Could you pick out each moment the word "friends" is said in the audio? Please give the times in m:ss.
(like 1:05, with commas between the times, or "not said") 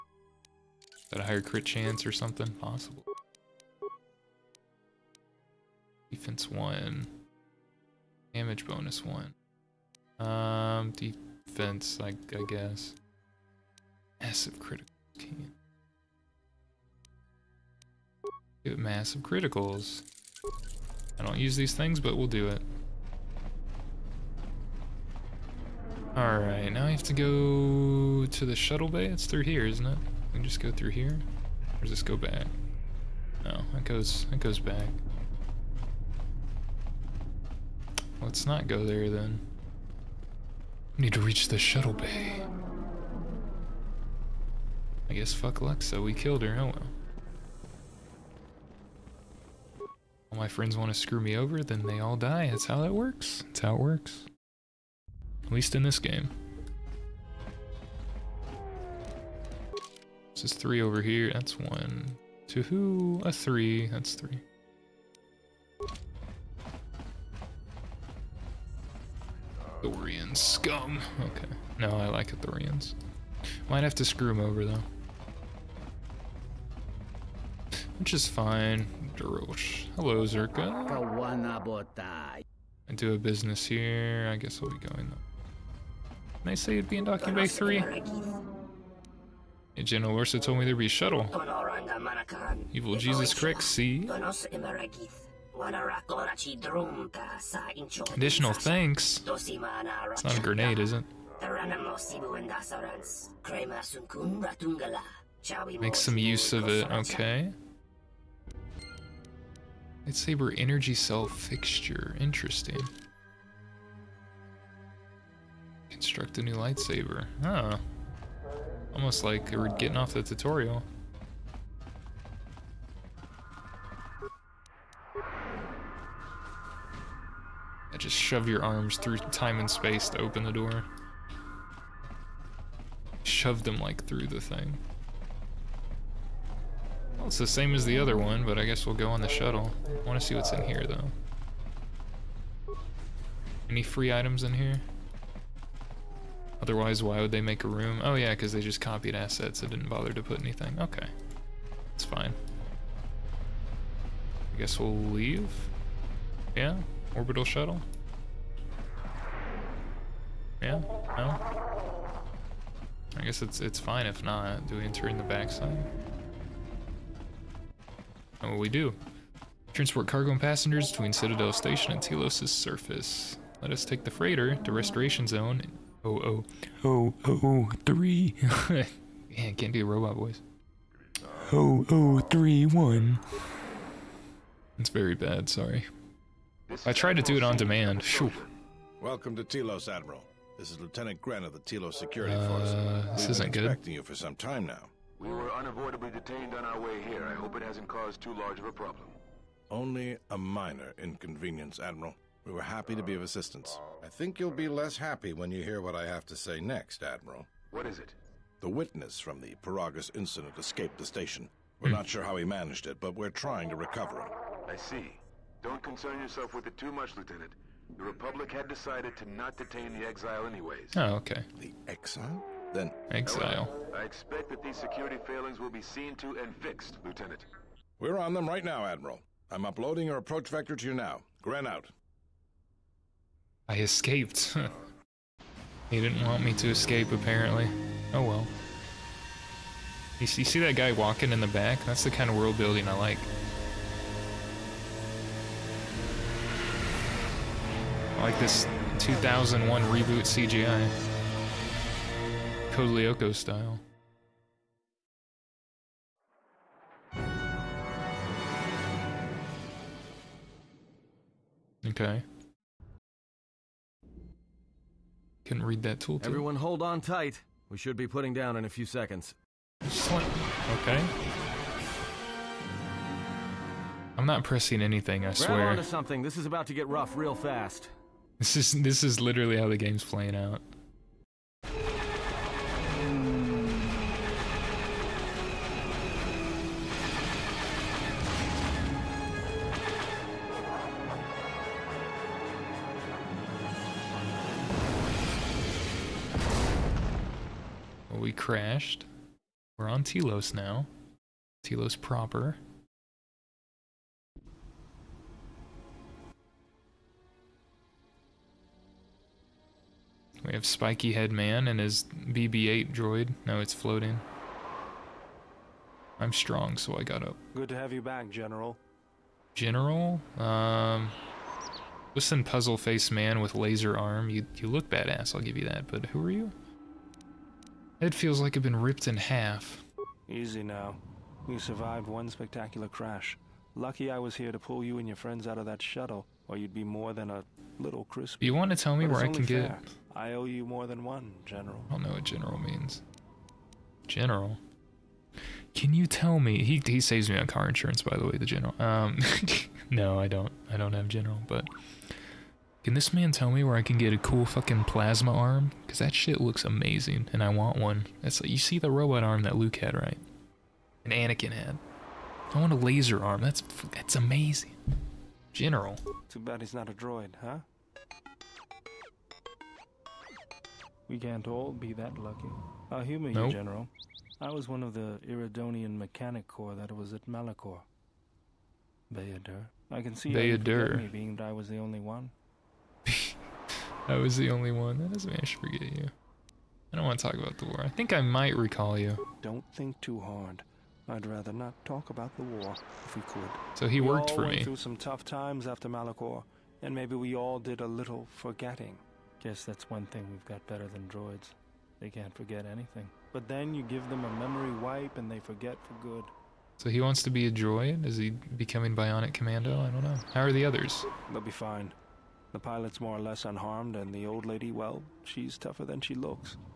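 0:50, 5:35.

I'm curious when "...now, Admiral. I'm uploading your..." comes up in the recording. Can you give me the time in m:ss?
3:48.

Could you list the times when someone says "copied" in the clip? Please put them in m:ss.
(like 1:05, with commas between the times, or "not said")
2:28.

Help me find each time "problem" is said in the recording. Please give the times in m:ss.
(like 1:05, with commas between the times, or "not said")
3:18.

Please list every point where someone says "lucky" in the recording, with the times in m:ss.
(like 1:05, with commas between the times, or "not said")
5:33, 6:12.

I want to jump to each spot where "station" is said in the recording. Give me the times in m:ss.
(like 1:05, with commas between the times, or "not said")
2:51, 3:31.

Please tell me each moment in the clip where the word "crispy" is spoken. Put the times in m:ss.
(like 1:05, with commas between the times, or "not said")
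5:38.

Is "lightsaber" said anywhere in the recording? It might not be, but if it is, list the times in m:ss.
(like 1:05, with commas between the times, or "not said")
1:50, 1:56.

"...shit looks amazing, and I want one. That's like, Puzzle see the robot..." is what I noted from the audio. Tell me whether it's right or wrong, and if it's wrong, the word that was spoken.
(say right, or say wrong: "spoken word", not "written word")
wrong: "You", not "Puzzle".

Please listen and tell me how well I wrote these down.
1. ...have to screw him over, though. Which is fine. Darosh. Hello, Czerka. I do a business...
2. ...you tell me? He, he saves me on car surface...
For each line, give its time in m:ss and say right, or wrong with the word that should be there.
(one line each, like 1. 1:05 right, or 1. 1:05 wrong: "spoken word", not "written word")
1. 1:13 right
2. 5:45 wrong: "insurance", not "surface".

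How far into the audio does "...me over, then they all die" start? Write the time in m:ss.
0:51.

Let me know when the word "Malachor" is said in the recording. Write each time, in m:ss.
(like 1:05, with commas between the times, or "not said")
6:17, 6:35.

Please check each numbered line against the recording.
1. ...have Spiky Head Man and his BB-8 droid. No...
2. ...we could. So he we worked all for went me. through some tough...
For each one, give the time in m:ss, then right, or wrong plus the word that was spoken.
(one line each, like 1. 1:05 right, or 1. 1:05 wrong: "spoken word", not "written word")
1. 5:10 right
2. 6:33 right.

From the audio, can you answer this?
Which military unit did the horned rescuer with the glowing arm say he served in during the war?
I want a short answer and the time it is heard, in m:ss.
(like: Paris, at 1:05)
Iridonian Mechanic Corps, at 6:15.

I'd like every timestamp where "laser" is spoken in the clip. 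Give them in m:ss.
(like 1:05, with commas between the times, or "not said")
5:23, 6:02.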